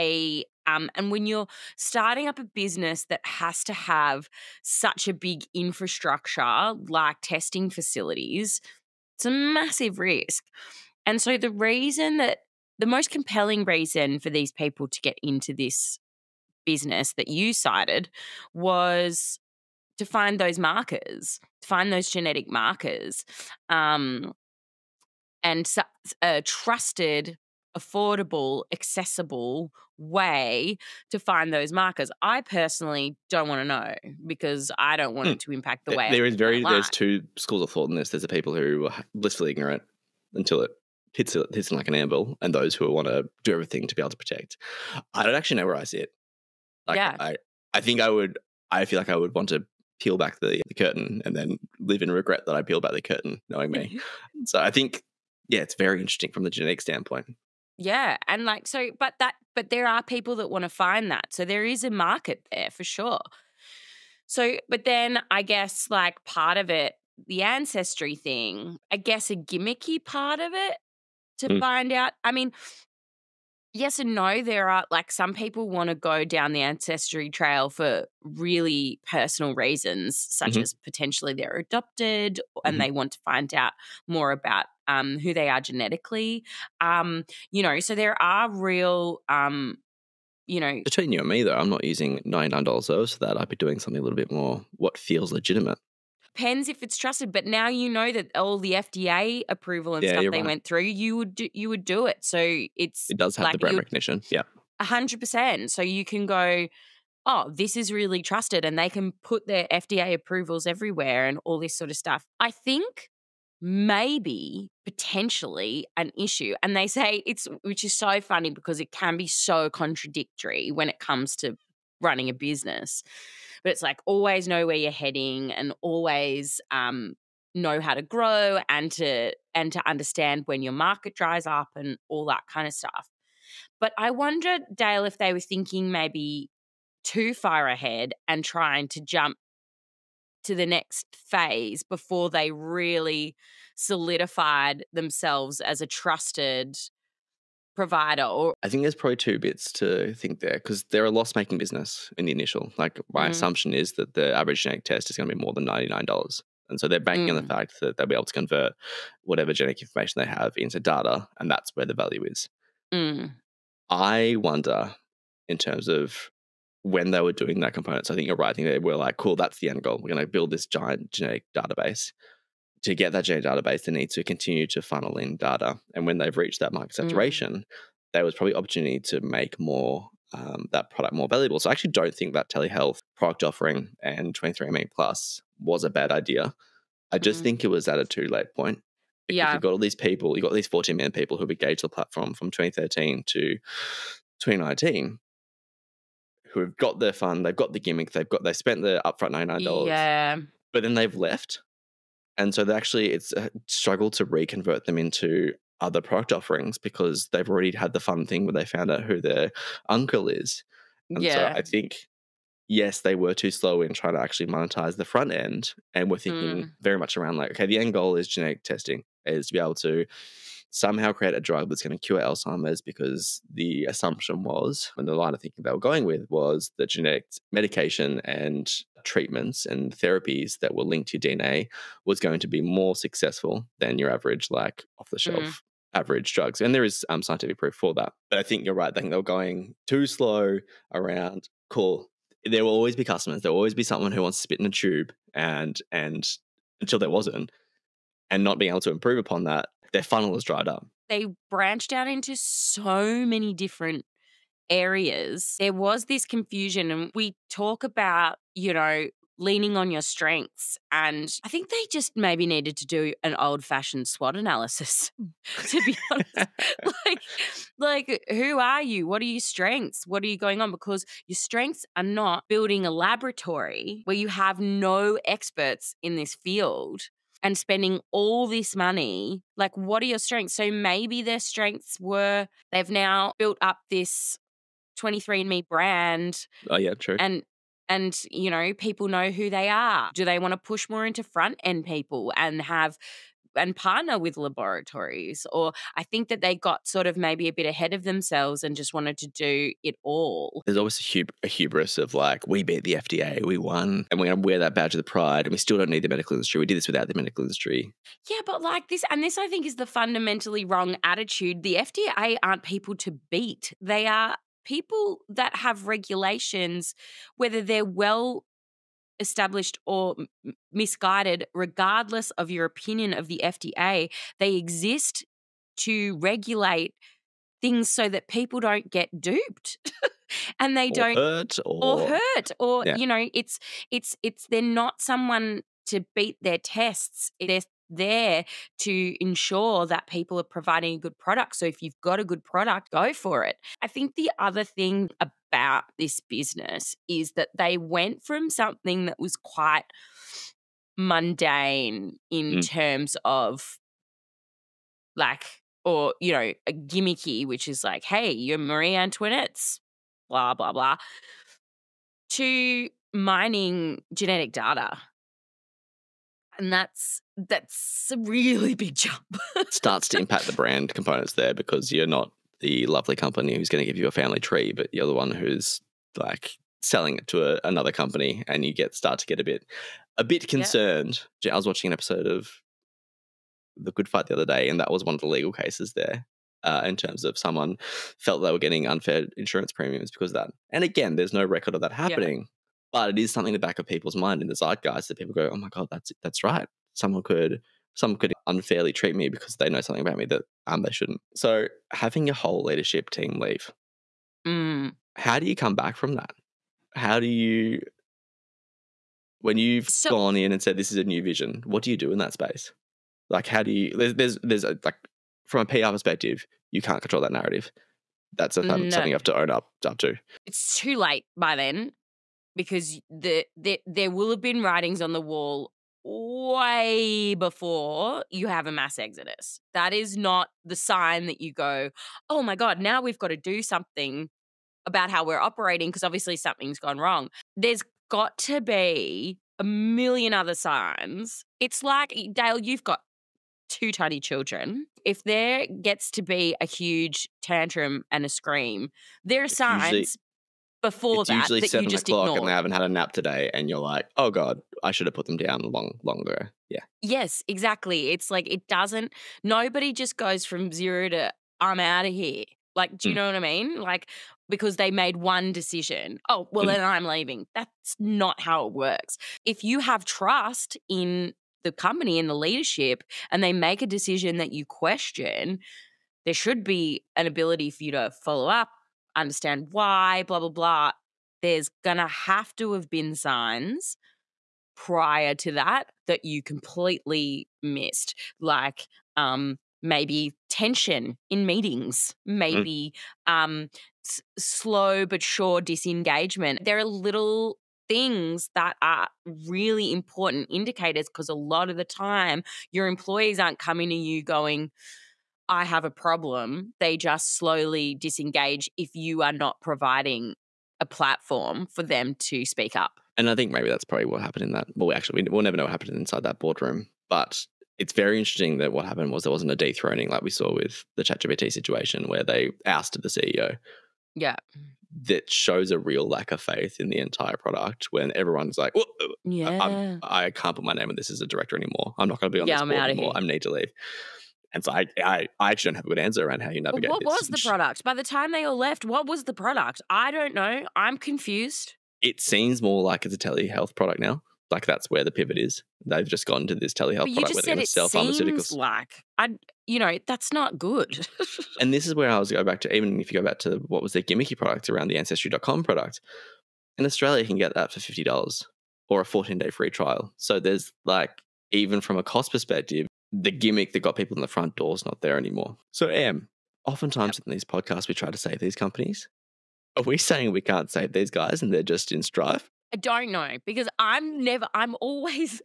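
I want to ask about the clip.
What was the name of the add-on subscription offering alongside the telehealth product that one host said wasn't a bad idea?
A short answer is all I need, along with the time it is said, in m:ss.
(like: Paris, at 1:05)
23andMe Plus, at 3:04.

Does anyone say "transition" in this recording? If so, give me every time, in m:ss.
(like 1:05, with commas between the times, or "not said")
not said.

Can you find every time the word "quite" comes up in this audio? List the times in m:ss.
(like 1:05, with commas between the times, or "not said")
5:49.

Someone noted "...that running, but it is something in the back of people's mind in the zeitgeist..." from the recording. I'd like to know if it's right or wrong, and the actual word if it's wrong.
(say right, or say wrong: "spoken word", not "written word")
wrong: "happening", not "running".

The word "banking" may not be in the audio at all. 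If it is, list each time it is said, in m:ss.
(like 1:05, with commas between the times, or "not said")
2:36.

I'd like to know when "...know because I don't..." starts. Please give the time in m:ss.
0:33.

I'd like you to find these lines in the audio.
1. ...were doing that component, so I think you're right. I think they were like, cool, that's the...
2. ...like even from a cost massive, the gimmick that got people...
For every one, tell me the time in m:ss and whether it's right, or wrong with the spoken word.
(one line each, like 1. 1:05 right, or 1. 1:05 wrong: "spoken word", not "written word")
1. 2:47 right
2. 9:20 wrong: "perspective", not "massive".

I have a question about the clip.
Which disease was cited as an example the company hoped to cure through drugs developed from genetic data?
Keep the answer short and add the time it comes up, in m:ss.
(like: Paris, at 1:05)
Alzheimer's, at 3:42.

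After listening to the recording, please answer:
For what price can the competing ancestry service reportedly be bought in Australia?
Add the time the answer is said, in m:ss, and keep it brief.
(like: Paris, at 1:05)
$50, at 9:17.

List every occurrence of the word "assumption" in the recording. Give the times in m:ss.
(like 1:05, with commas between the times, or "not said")
2:33, 3:43.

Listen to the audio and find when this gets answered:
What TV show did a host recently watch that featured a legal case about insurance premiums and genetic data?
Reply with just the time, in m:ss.
6:23.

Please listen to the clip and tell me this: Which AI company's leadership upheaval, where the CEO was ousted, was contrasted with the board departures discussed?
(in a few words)
ChatGPT.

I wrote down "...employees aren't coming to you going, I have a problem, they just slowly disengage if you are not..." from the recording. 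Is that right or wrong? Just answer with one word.
right.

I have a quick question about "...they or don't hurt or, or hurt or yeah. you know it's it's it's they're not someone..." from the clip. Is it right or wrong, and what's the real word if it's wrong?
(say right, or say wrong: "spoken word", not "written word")
right.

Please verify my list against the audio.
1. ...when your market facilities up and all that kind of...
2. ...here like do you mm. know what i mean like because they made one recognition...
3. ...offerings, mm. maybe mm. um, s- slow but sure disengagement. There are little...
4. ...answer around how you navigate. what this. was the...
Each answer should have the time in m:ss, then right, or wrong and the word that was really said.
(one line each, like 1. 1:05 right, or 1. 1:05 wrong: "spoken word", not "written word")
1. 2:10 wrong: "dries", not "facilities"
2. 7:42 wrong: "decision", not "recognition"
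3. 8:11 wrong: "meetings", not "offerings"
4. 8:55 right.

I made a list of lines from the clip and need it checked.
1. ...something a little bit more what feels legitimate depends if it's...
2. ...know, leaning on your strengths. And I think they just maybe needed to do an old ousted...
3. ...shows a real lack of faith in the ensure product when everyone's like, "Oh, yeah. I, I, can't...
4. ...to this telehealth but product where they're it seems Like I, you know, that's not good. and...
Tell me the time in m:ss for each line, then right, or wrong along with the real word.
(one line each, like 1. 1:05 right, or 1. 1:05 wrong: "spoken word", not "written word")
1. 1:33 right
2. 4:18 wrong: "fashioned", not "ousted"
3. 8:45 wrong: "entire", not "ensure"
4. 9:06 right.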